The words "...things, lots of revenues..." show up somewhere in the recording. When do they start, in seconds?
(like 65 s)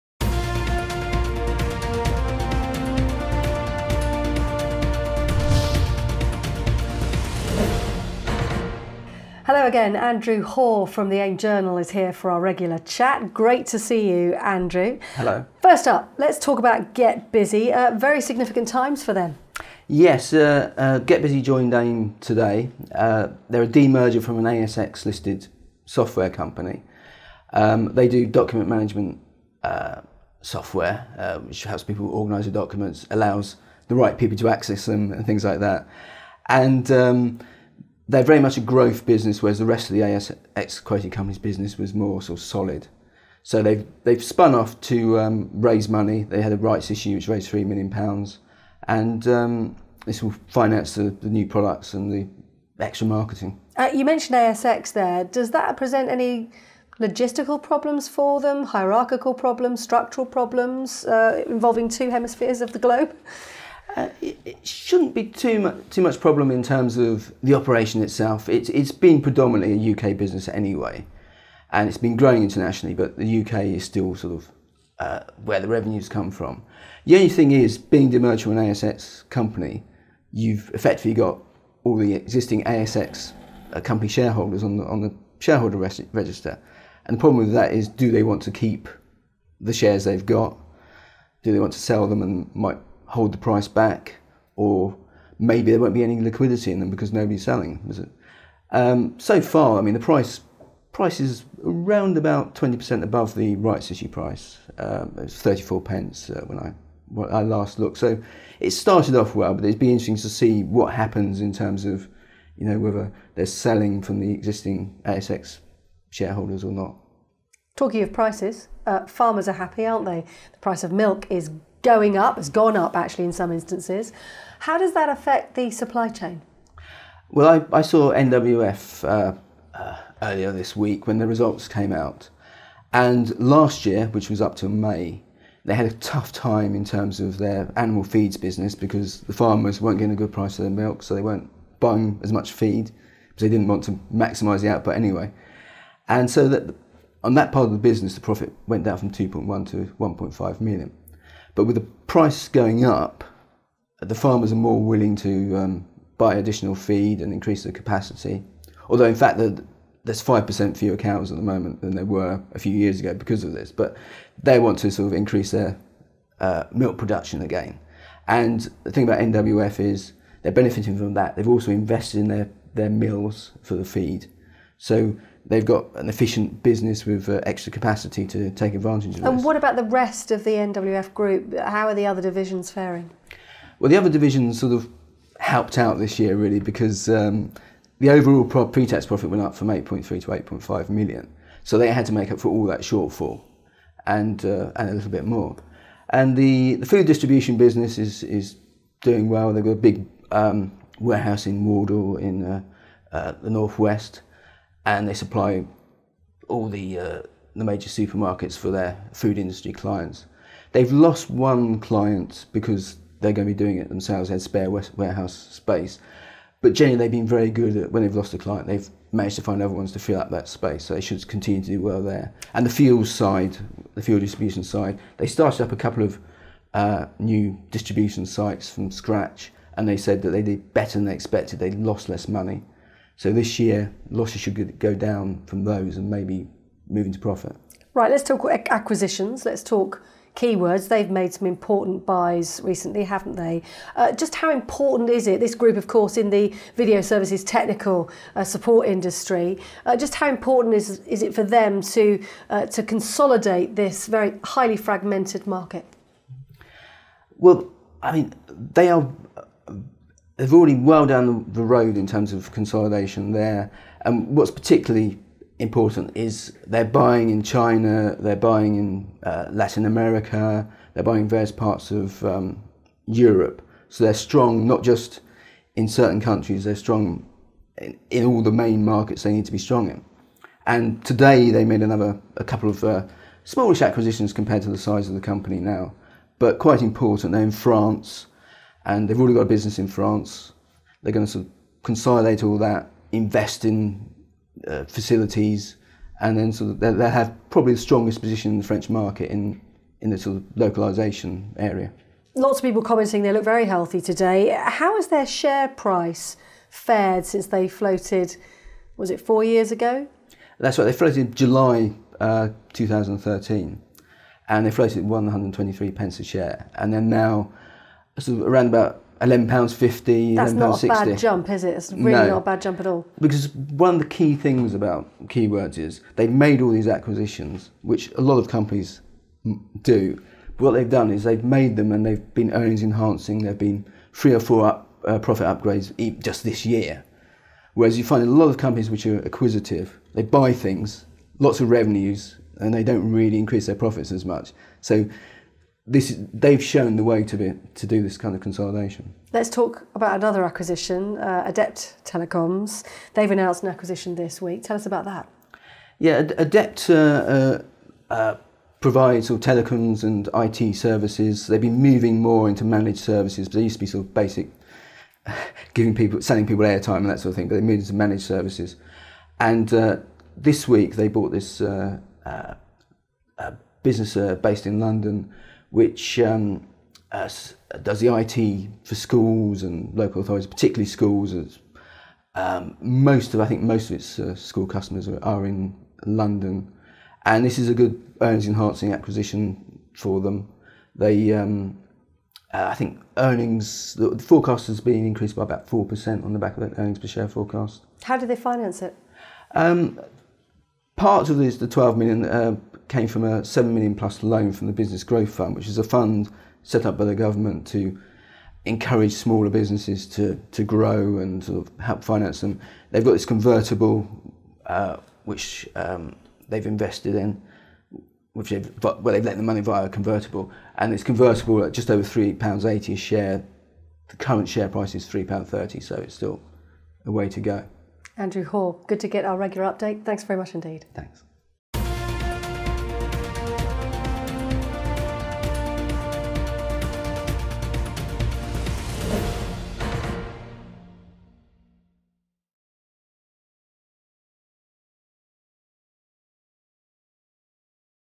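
340 s.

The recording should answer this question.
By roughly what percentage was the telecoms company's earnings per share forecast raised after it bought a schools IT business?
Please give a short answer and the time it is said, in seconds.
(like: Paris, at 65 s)
4%, at 395 s.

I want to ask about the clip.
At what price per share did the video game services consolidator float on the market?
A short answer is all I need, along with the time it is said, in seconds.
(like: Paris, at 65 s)
123 pence, at 315 s.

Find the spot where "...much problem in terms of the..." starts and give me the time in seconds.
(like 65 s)
66 s.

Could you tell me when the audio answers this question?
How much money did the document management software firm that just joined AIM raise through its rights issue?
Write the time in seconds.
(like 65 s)
47 s.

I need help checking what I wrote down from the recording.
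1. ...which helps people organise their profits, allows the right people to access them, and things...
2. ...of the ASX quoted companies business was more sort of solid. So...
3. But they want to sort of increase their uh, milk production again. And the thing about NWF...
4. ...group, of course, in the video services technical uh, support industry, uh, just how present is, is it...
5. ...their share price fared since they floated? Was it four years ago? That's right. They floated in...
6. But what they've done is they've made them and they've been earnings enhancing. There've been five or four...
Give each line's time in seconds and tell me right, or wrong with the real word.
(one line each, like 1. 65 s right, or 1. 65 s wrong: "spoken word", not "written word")
1. 31 s wrong: "documents", not "profits"
2. 39 s right
3. 163 s right
4. 245 s wrong: "important", not "present"
5. 305 s right
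6. 330 s wrong: "three", not "five".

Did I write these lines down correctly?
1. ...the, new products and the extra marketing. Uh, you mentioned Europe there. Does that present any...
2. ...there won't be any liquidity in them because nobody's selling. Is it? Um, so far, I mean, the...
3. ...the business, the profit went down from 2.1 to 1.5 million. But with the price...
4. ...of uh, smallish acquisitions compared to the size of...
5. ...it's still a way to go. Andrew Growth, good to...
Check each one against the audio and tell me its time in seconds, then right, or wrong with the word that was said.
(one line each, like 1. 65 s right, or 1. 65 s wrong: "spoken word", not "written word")
1. 51 s wrong: "ASX", not "Europe"
2. 95 s right
3. 147 s right
4. 282 s right
5. 425 s wrong: "Hore", not "Growth".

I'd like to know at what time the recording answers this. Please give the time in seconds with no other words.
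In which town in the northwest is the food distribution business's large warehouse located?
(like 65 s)
201 s.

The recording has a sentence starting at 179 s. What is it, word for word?
what about the rest of the NWF group?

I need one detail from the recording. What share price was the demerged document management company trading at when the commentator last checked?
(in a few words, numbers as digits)
34 pence.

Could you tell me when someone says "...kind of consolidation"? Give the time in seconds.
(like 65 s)
348 s.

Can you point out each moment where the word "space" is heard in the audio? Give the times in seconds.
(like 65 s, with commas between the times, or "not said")
215 s, 220 s.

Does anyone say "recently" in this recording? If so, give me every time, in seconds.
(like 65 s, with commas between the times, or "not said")
242 s.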